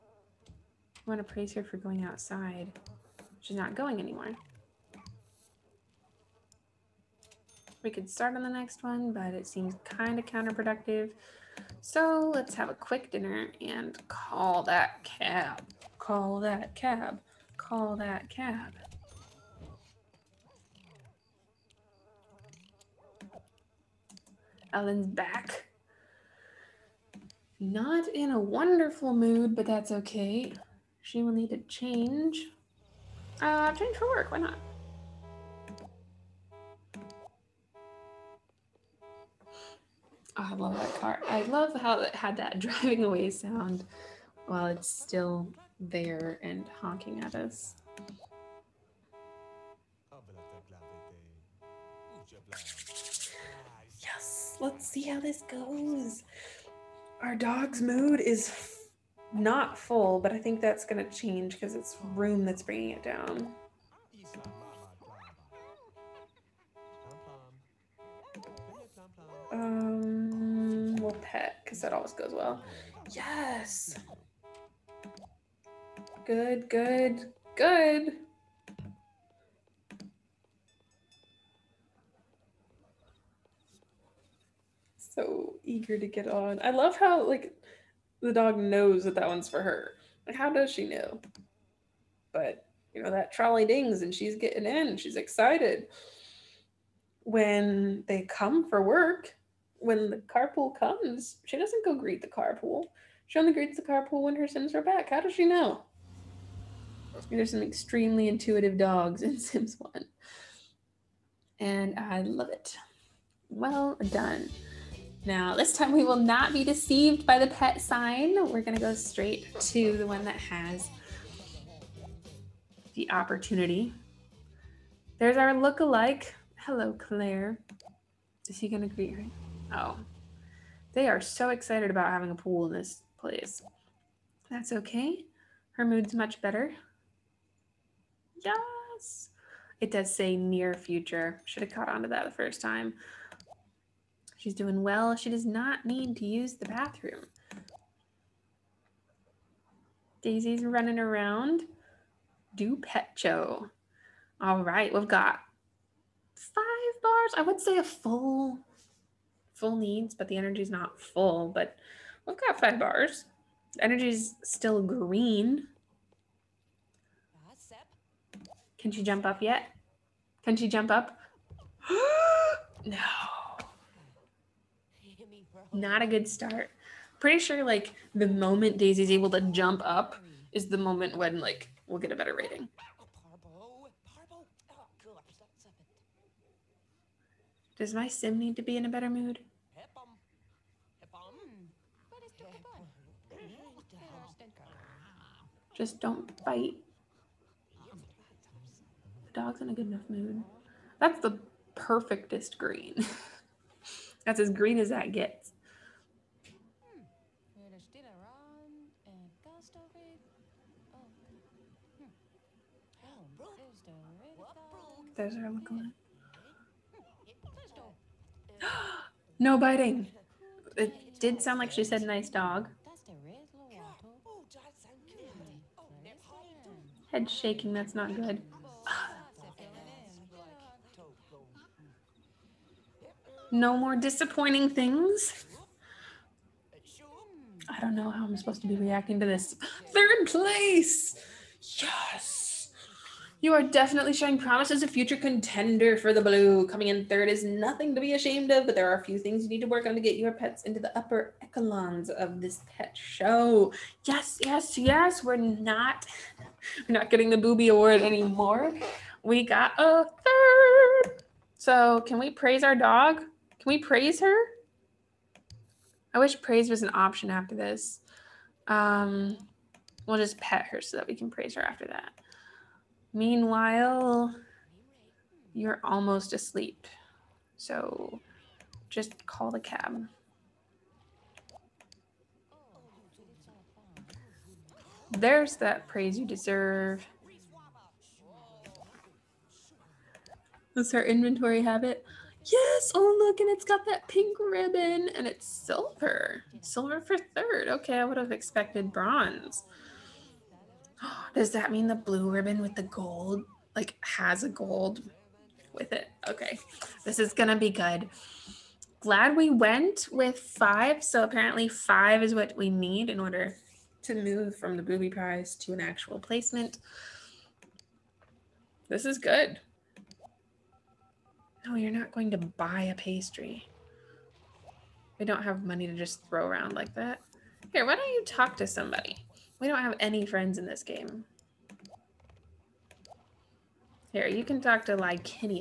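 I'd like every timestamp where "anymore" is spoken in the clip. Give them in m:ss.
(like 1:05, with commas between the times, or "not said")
0:03, 4:18.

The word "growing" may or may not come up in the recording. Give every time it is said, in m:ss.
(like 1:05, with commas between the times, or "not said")
not said.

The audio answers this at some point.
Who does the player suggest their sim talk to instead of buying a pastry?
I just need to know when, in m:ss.
5:34.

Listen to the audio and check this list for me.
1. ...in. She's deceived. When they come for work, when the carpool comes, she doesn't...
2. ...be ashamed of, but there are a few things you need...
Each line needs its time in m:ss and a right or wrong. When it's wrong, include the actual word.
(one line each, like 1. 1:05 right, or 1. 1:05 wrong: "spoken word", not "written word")
1. 1:34 wrong: "excited", not "deceived"
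2. 4:07 right.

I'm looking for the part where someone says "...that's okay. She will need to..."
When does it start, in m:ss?
0:29.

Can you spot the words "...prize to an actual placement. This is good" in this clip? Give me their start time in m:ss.
5:15.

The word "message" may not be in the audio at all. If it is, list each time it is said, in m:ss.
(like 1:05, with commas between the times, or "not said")
not said.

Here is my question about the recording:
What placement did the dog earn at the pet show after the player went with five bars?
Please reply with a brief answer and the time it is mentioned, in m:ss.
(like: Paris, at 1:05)
Third place, at 3:59.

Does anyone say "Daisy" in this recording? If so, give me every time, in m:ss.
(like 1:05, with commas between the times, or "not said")
2:30, 2:58.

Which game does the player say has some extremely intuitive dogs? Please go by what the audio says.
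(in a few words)
Sims 1.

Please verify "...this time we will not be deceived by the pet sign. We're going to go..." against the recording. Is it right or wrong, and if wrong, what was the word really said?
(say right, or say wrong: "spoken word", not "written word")
right.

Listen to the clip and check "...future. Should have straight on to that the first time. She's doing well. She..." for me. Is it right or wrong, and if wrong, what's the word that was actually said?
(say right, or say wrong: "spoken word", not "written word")
wrong: "caught", not "straight".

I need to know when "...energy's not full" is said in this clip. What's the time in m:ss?
2:40.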